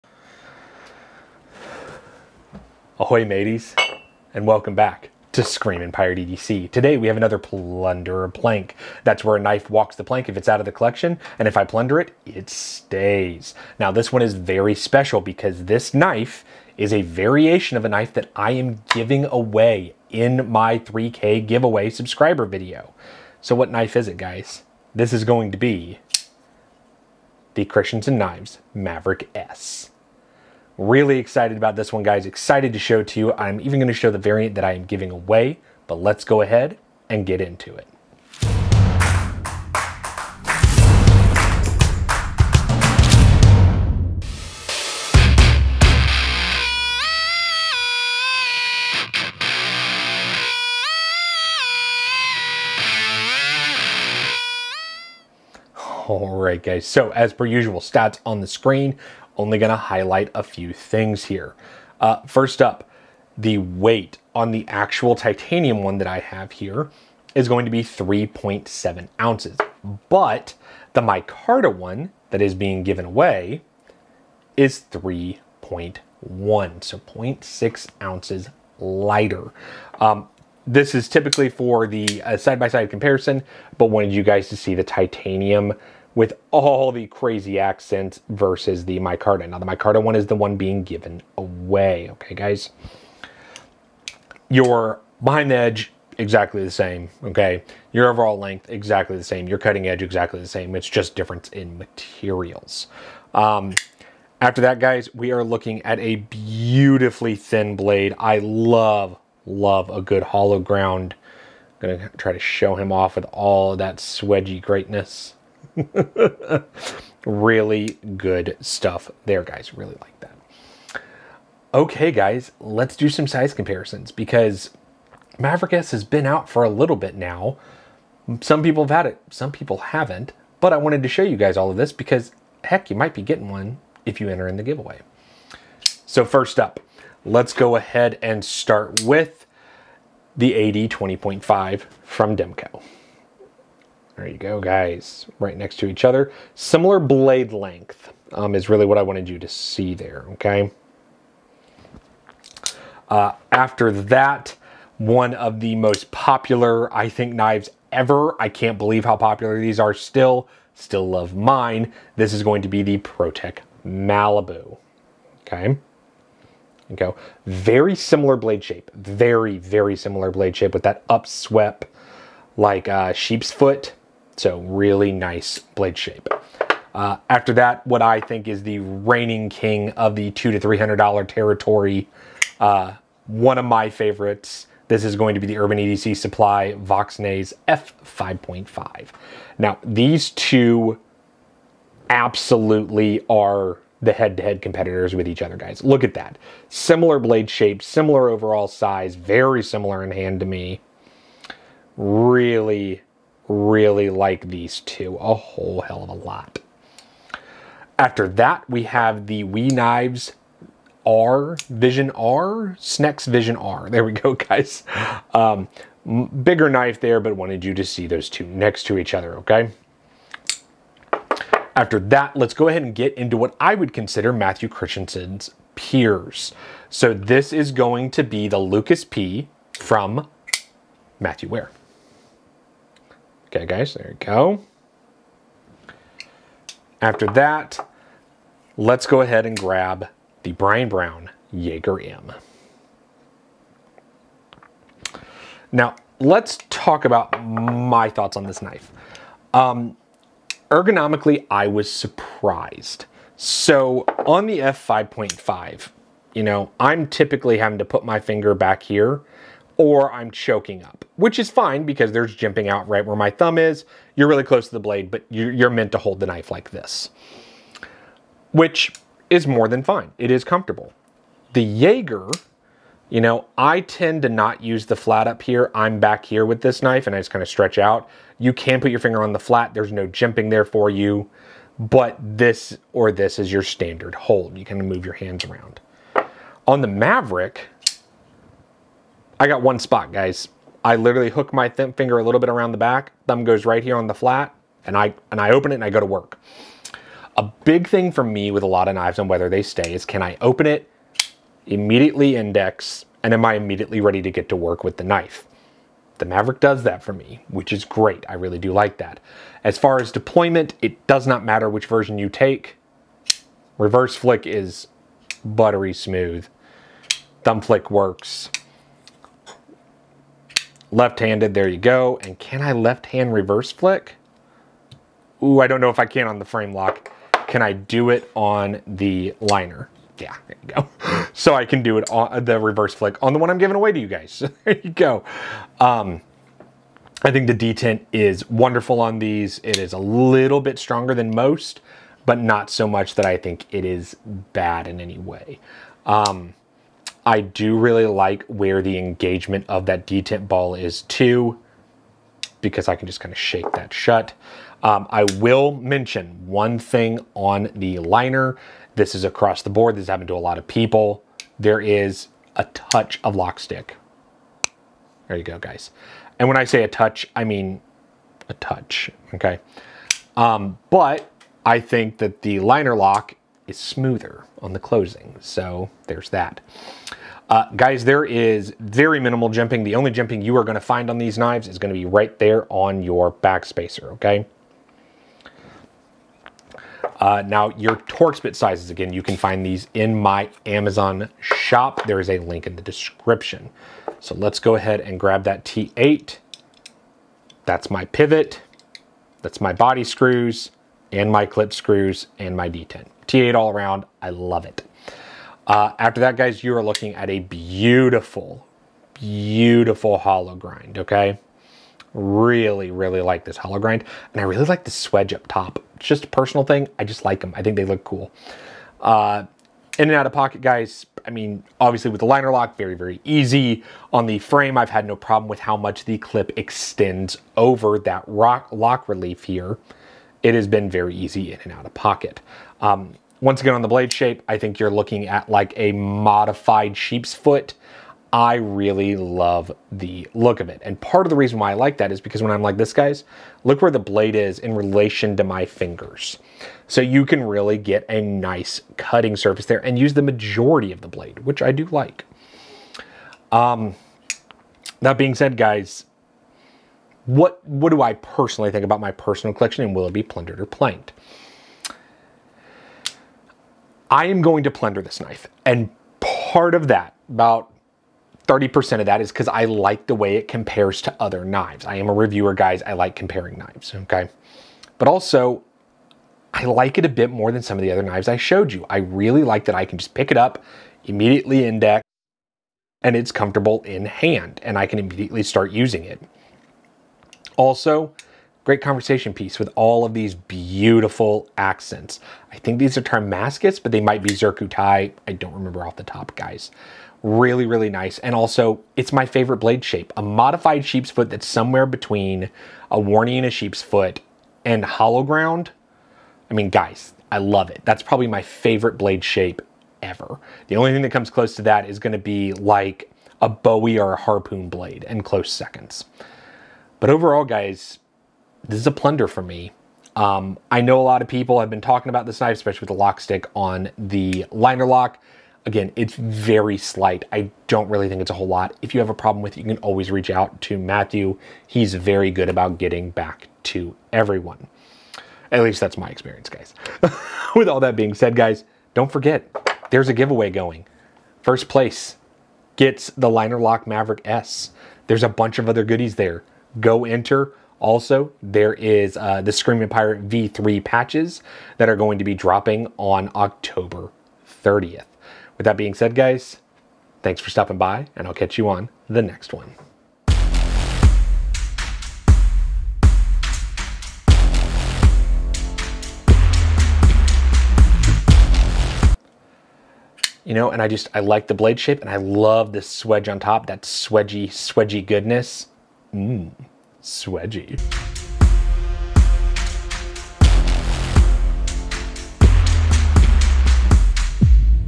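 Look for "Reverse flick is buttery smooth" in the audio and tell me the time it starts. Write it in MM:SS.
05:13.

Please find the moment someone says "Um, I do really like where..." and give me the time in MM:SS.
05:46.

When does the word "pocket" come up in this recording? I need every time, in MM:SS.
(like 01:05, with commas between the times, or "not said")
07:00, 07:11.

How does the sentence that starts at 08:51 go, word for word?
He's very good about getting back to everyone.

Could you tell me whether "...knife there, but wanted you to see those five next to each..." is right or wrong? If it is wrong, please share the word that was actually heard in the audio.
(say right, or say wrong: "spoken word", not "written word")
wrong: "two", not "five".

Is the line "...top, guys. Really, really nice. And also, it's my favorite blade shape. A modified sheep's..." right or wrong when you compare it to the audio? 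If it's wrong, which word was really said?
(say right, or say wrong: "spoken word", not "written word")
right.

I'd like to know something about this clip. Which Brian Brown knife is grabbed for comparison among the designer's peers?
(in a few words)
Jaeger M.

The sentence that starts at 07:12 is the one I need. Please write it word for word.
Um, once again, on the blade shape, I think you're looking at like a modified sheep's foot.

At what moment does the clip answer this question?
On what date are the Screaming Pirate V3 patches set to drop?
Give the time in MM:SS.
09:13.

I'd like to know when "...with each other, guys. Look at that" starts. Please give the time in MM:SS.
03:15.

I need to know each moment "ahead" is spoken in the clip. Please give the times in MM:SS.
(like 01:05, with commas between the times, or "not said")
00:36, 02:17, 03:42, 03:59, 06:34.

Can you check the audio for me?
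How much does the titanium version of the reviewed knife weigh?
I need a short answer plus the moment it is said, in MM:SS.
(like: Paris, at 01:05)
3.7 ounces, at 01:07.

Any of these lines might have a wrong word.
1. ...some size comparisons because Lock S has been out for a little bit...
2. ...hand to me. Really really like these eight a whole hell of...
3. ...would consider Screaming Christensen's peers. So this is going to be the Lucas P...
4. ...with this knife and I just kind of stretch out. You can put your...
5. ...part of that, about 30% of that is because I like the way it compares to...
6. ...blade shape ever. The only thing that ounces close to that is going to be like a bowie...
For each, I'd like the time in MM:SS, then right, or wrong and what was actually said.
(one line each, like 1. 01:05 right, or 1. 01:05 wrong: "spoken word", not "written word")
1. 02:03 wrong: "Maverick", not "Lock"
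2. 03:20 wrong: "two", not "eight"
3. 03:43 wrong: "Matthew", not "Screaming"
4. 04:36 right
5. 07:46 right
6. 08:28 wrong: "comes", not "ounces".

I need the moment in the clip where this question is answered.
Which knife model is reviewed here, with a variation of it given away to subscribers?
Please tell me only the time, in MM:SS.
00:27.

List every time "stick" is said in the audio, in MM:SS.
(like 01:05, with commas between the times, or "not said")
06:03, 08:43.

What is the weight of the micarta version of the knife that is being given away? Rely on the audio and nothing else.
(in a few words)
3.1.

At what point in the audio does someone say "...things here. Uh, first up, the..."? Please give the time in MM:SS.
01:00.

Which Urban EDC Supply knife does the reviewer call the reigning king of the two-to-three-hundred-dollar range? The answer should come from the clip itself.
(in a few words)
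Voxnaes F5.5.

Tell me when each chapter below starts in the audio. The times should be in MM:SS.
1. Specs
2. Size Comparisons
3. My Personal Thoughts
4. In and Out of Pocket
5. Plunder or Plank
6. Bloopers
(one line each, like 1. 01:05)
1. 00:58
2. 02:21
3. 04:11
4. 07:01
5. 07:44
6. 09:28.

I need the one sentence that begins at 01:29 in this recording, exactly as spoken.
Now, the micarta one is the one being given away, okay, guys?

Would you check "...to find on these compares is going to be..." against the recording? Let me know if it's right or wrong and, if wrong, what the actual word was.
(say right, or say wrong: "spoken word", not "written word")
wrong: "knives", not "compares".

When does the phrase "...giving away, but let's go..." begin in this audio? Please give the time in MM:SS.
00:34.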